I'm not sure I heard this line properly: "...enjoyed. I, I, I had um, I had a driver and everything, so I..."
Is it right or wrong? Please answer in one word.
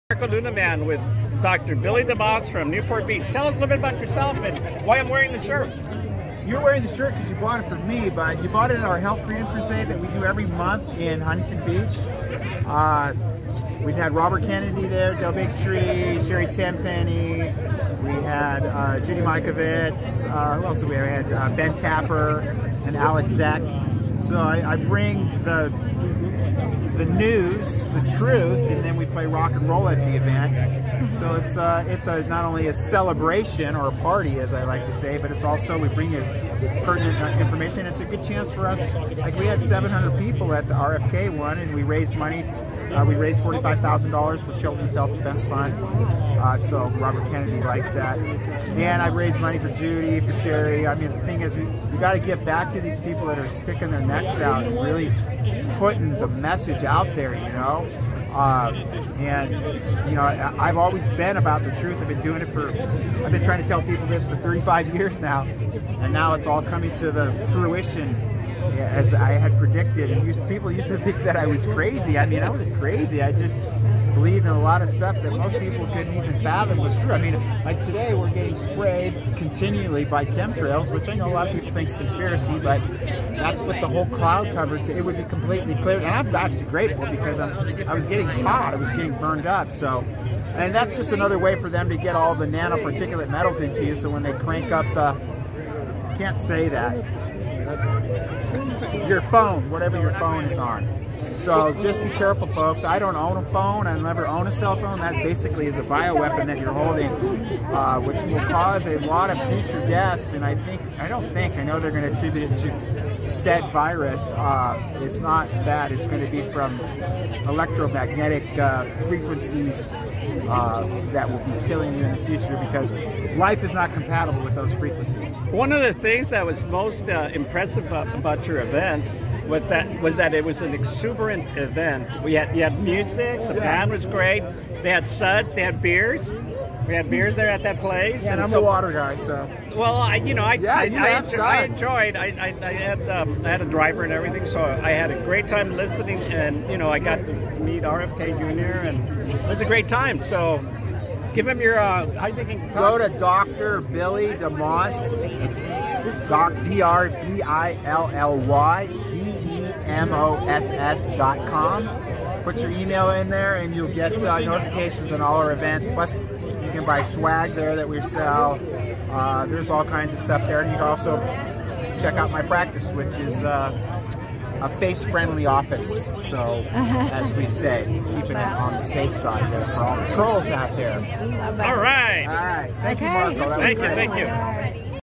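right.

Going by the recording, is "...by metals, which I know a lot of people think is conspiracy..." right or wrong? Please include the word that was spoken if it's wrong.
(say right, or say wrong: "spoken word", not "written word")
wrong: "chemtrails", not "metals".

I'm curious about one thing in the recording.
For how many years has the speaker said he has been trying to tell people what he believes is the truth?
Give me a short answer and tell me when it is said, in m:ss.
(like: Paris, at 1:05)
35 years, at 1:04.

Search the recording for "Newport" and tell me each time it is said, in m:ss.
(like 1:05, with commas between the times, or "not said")
0:02.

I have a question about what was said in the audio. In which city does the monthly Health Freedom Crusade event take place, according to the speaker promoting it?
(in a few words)
Huntington Beach.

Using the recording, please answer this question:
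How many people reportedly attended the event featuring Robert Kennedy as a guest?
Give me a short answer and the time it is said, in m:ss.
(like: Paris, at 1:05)
700, at 0:39.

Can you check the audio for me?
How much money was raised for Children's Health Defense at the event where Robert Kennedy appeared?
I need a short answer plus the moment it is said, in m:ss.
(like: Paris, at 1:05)
$45,000, at 0:43.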